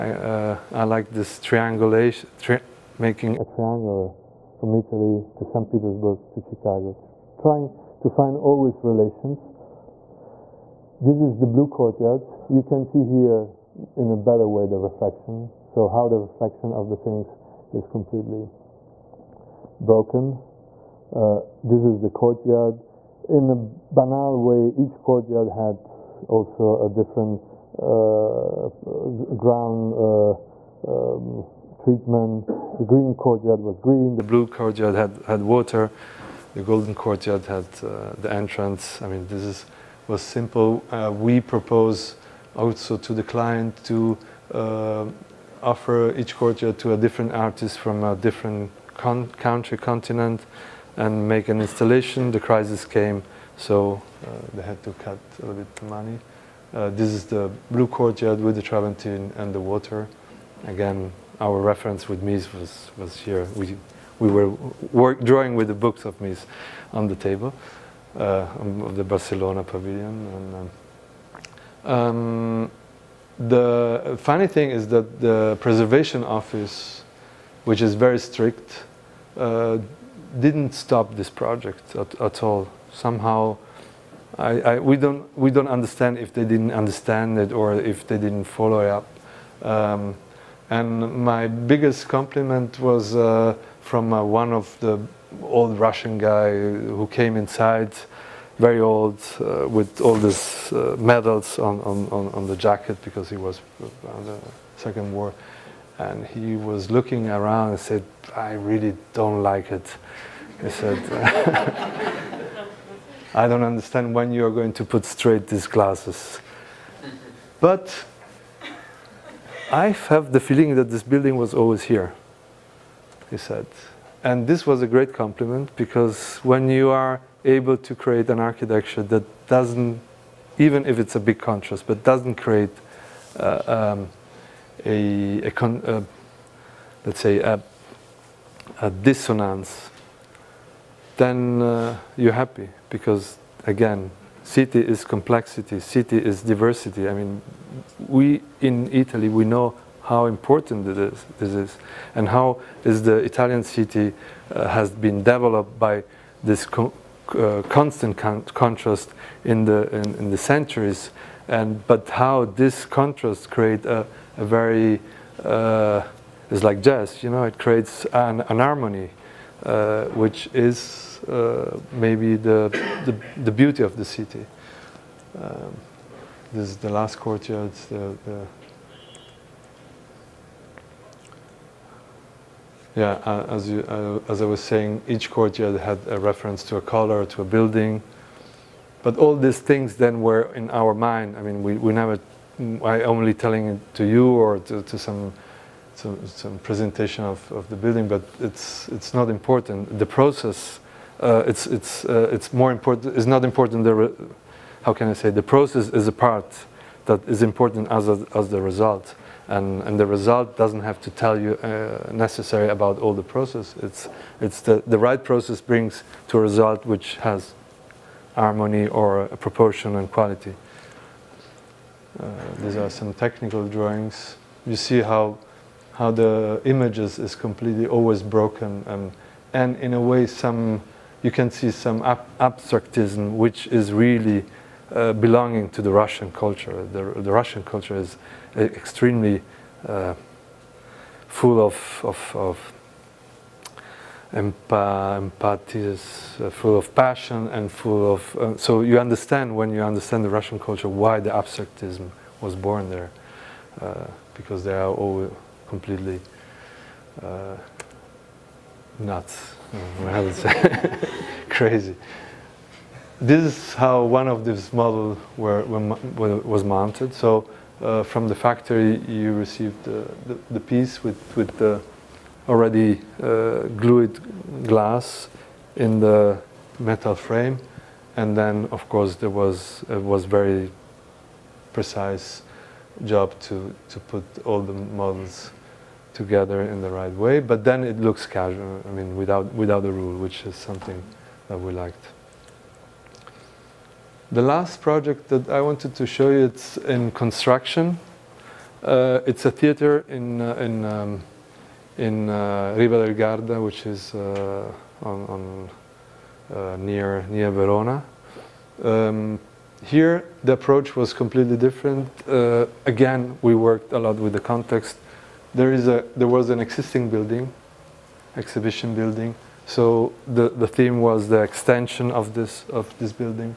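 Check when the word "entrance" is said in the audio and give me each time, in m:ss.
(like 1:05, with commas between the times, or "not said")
0:38.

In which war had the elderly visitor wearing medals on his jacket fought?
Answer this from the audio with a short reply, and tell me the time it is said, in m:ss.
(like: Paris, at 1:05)
Second War, at 1:44.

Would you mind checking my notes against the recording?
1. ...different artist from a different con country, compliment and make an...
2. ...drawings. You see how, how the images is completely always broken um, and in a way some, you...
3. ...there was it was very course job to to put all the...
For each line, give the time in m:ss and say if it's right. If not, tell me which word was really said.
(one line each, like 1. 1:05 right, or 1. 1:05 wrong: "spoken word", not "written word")
1. 0:46 wrong: "continent", not "compliment"
2. 3:43 right
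3. 4:39 wrong: "precise", not "course".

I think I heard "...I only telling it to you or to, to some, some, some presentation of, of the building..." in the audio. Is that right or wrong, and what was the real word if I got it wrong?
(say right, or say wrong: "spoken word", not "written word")
right.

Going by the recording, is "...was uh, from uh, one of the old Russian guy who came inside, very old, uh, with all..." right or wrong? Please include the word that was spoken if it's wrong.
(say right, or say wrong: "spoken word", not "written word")
right.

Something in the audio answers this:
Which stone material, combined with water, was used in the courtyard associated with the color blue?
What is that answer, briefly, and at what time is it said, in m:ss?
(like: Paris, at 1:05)
Travertine, at 0:58.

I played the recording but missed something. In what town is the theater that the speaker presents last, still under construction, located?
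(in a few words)
Riva del Garda.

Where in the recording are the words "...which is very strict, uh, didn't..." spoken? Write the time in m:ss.
1:17.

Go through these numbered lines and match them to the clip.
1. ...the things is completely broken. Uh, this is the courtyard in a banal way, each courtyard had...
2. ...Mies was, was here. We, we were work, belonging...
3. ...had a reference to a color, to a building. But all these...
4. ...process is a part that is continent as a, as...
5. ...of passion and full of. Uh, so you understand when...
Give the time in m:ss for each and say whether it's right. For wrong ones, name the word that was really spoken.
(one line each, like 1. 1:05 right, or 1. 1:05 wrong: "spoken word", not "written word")
1. 0:16 right
2. 1:02 wrong: "drawing", not "belonging"
3. 3:05 right
4. 3:25 wrong: "important", not "continent"
5. 4:06 right.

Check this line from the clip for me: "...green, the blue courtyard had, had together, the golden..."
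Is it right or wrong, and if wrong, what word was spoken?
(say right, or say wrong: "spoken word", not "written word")
wrong: "water", not "together".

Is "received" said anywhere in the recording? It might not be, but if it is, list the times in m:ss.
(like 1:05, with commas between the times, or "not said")
4:29.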